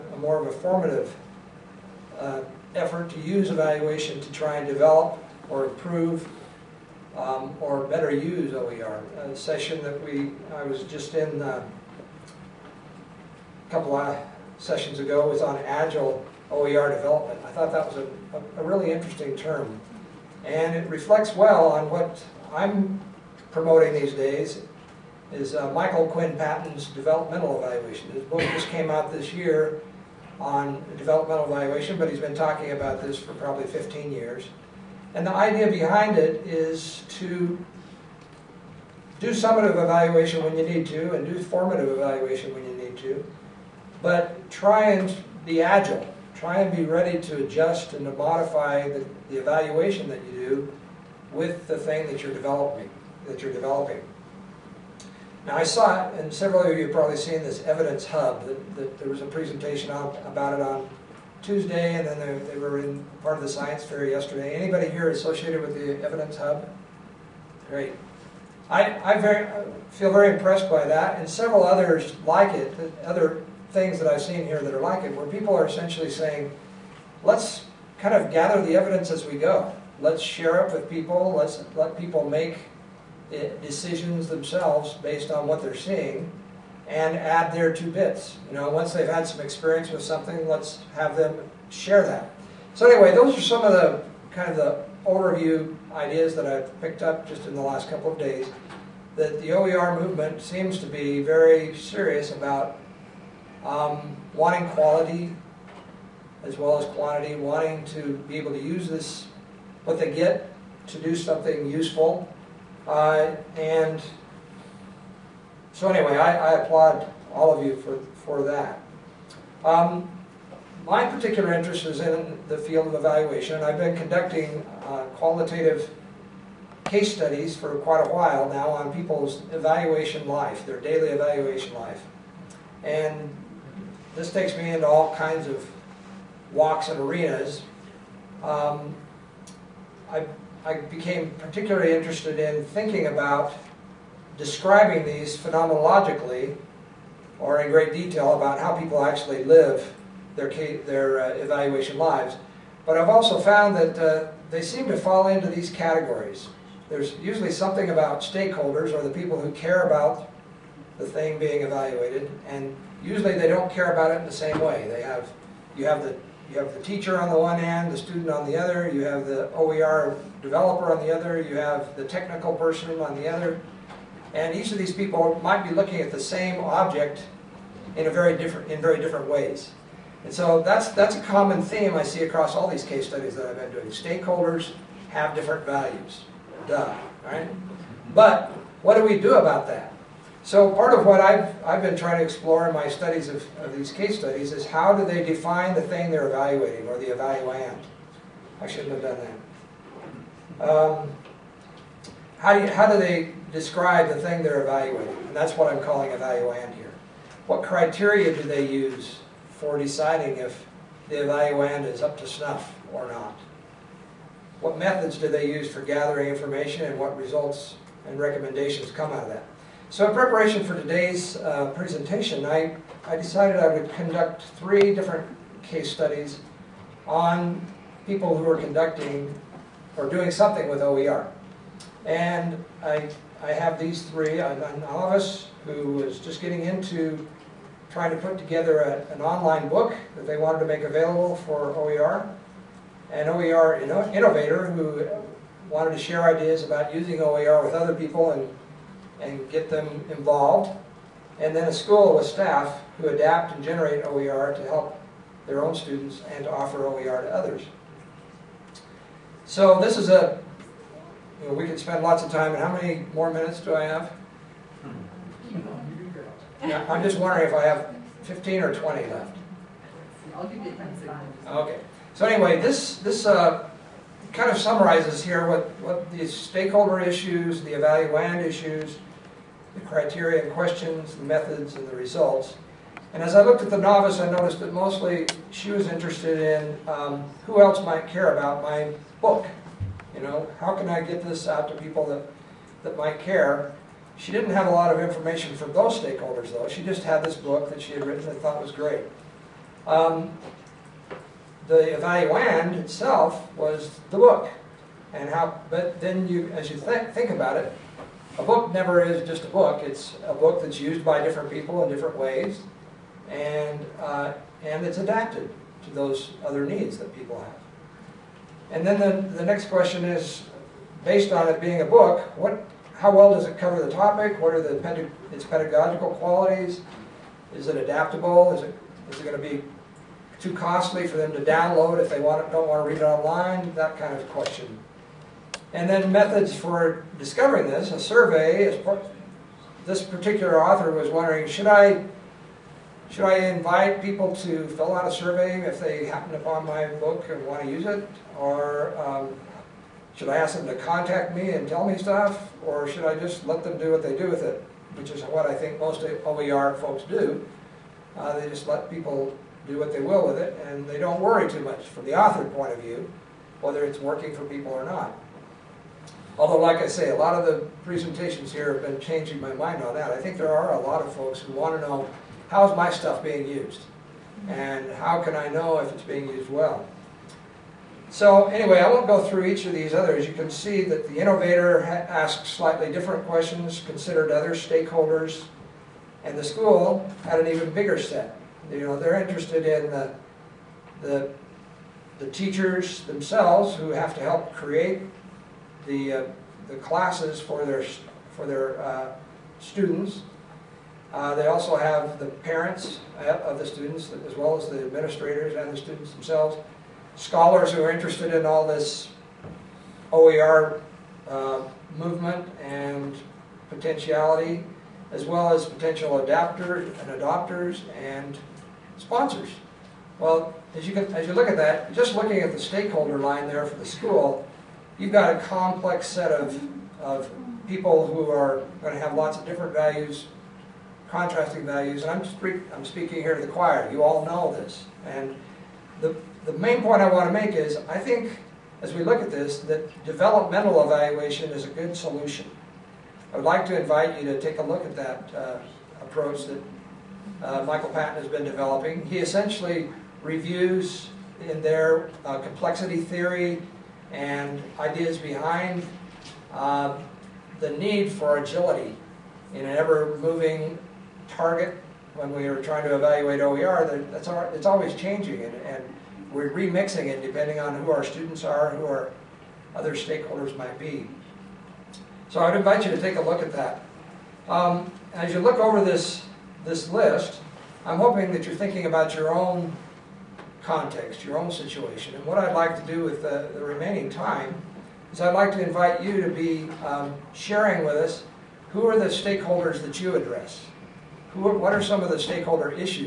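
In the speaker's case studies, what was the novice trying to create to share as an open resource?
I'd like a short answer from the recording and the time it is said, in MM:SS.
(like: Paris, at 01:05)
an online book, at 03:59.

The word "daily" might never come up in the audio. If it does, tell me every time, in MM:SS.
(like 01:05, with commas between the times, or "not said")
02:10.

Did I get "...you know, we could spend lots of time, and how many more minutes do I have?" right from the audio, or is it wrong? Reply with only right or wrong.
right.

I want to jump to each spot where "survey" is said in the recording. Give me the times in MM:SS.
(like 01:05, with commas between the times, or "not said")
05:37, 05:45.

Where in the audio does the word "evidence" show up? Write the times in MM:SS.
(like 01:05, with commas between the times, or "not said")
00:57, 01:06, 01:18.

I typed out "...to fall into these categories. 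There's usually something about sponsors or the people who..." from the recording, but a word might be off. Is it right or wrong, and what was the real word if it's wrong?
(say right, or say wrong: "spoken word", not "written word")
wrong: "stakeholders", not "sponsors".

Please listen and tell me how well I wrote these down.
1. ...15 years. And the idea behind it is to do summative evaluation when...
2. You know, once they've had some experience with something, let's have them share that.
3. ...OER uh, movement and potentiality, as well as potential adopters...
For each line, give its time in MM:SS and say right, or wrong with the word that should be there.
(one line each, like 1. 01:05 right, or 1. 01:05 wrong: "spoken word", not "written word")
1. 00:33 right
2. 01:28 right
3. 06:50 wrong: "adapters", not "adopters".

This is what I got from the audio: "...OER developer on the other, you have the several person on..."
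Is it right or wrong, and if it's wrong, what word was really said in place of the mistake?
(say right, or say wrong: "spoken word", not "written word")
wrong: "technical", not "several".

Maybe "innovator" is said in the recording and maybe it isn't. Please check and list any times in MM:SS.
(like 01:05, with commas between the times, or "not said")
04:04, 06:21.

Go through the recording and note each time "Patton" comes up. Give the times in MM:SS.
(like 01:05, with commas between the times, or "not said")
00:26, 07:27.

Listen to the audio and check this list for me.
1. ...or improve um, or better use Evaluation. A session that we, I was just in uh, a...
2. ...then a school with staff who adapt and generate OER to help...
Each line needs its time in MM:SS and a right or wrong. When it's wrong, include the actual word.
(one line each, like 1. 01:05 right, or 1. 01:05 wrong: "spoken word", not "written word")
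1. 00:05 wrong: "OER", not "Evaluation"
2. 04:11 right.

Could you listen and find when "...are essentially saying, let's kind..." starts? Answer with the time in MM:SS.
01:15.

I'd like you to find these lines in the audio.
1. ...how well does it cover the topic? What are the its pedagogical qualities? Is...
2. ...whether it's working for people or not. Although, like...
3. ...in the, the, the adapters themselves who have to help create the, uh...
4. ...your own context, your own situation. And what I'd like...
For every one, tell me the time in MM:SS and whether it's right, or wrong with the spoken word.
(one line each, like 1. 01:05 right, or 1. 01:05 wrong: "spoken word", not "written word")
1. 05:22 right
2. 06:03 right
3. 06:29 wrong: "teachers", not "adapters"
4. 07:59 right.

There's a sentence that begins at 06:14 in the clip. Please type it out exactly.
And how can I know if it's being used well?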